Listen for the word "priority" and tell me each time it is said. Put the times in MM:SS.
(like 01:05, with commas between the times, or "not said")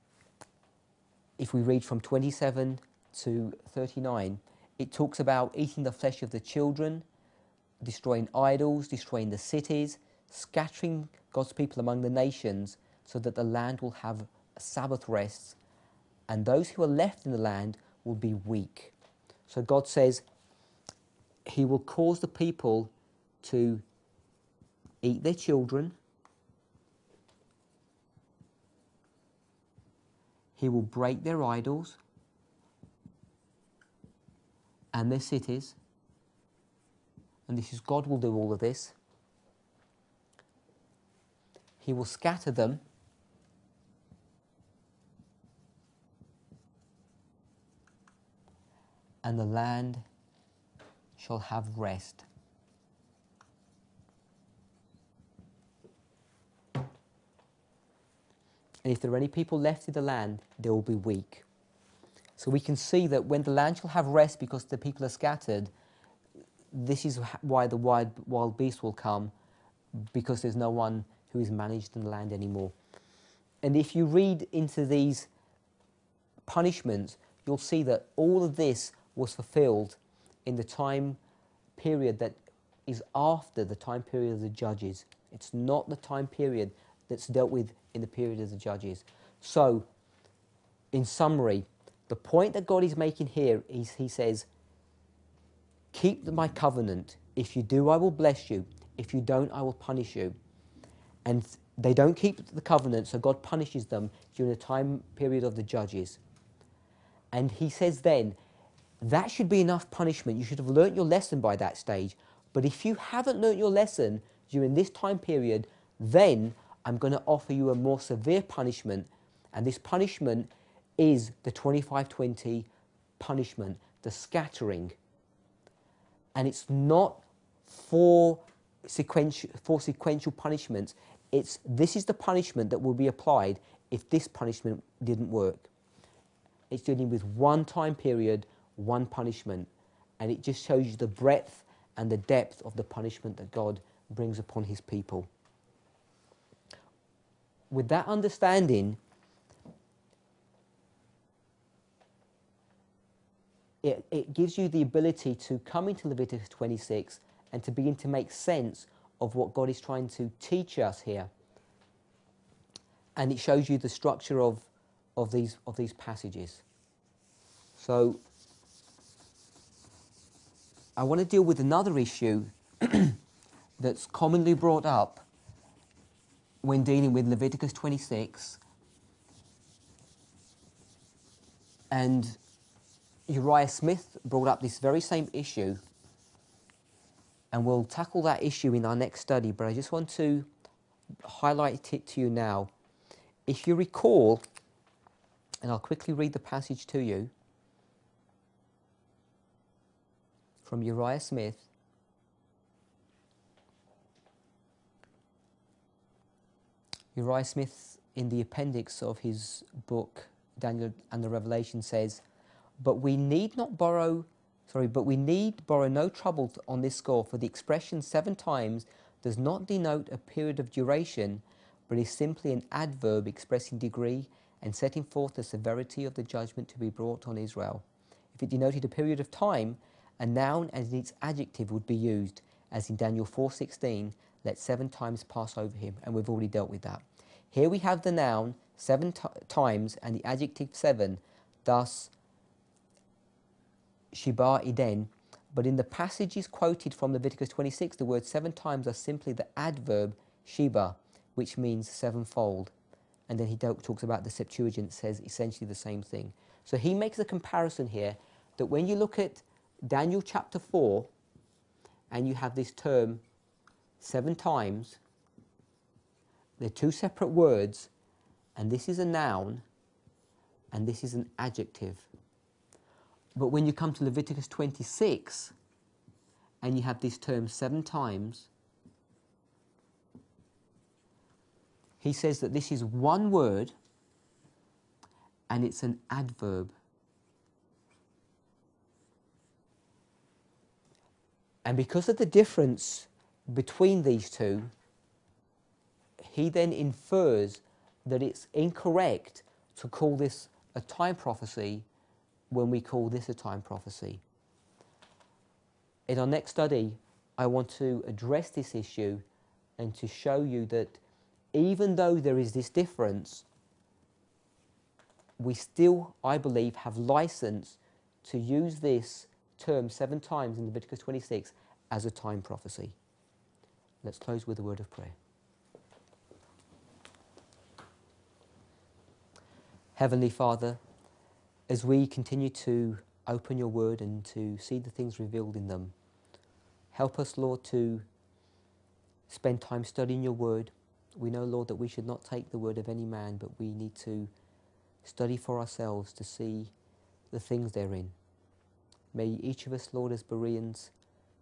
not said.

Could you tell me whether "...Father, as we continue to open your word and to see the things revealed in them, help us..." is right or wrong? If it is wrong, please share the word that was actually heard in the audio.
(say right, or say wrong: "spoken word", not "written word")
right.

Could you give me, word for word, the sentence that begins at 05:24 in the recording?
Let's close with a word of prayer.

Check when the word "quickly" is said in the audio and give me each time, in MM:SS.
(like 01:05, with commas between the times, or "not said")
03:15.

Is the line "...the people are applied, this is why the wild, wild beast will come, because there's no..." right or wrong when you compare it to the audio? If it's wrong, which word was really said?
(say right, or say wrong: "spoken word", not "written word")
wrong: "scattered", not "applied".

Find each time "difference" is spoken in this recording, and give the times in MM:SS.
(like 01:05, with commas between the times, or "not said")
04:52, 05:12.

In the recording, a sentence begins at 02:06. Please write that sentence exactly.
And it's not for sequential, for sequential punishments.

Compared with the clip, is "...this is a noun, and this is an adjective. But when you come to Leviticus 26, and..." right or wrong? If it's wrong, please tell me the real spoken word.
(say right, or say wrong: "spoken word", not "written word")
right.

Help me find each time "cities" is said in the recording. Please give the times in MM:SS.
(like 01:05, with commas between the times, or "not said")
00:09, 00:35.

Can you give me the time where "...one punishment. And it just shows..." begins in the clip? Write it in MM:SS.
02:18.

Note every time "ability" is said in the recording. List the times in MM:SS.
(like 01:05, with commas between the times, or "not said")
02:34.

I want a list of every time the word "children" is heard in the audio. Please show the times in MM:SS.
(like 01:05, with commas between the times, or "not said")
00:06, 00:25.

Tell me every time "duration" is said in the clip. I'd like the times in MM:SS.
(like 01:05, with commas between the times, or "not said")
03:40.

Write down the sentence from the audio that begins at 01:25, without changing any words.
It's not the time period that's dealt with in the period of the judges.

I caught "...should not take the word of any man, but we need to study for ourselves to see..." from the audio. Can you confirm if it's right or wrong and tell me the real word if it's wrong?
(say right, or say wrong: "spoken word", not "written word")
right.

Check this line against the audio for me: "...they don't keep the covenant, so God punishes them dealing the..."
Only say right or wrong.
wrong.